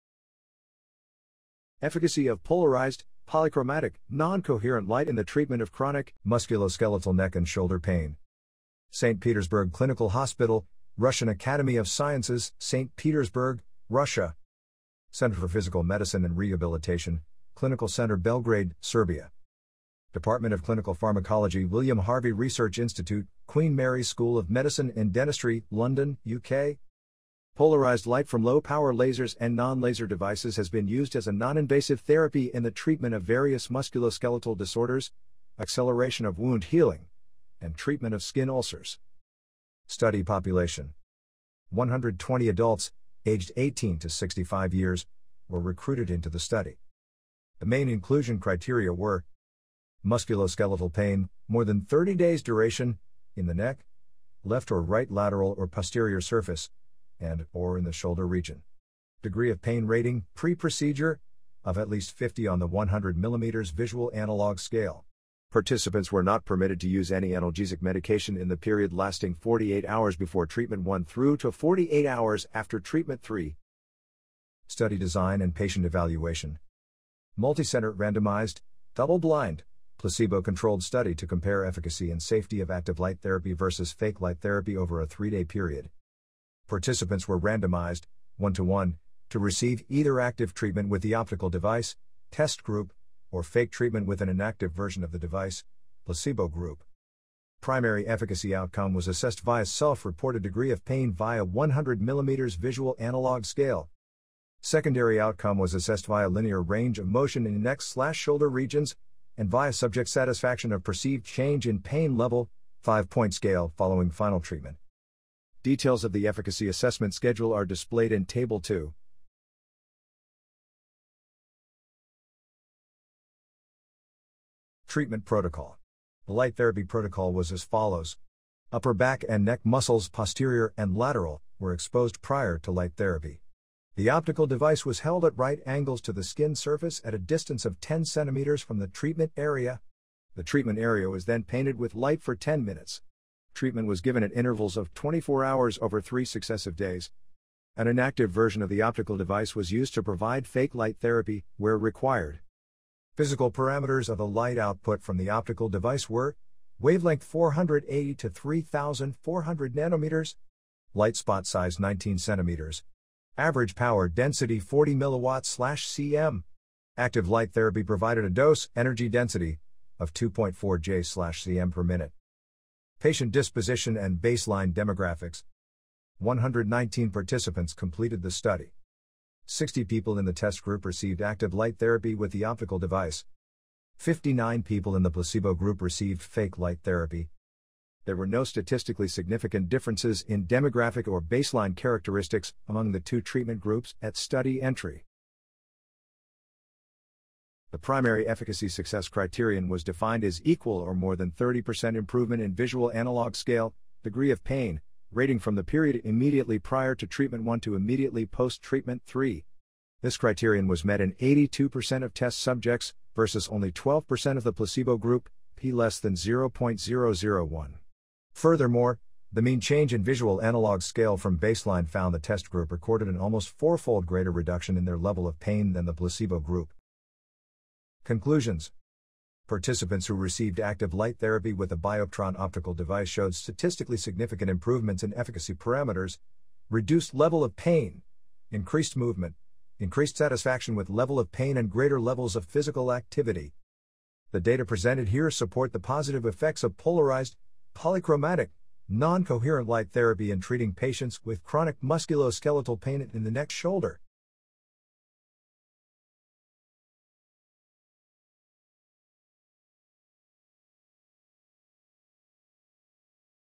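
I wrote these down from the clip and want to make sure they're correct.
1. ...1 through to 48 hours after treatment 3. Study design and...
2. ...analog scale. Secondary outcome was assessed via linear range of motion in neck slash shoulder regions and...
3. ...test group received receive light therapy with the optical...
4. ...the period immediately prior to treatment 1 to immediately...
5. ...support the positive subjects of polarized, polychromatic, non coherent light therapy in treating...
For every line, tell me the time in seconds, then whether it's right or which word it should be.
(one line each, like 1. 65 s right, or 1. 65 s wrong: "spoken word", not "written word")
1. 70 s right
2. 102 s right
3. 180 s wrong: "active", not "receive"
4. 205 s right
5. 245 s wrong: "effects", not "subjects".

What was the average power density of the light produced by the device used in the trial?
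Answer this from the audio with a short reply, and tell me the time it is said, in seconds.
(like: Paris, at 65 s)
40 milliwatts/cm, at 164 s.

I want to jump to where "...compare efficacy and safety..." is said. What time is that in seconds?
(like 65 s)
81 s.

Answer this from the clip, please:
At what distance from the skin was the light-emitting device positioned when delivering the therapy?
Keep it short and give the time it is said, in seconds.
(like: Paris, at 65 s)
10 centimeters, at 137 s.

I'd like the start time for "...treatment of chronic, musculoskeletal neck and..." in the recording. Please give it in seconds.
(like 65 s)
5 s.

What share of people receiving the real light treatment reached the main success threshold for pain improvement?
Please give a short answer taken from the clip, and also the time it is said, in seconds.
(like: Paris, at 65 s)
82%, at 211 s.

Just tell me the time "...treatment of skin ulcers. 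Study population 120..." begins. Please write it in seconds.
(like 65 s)
37 s.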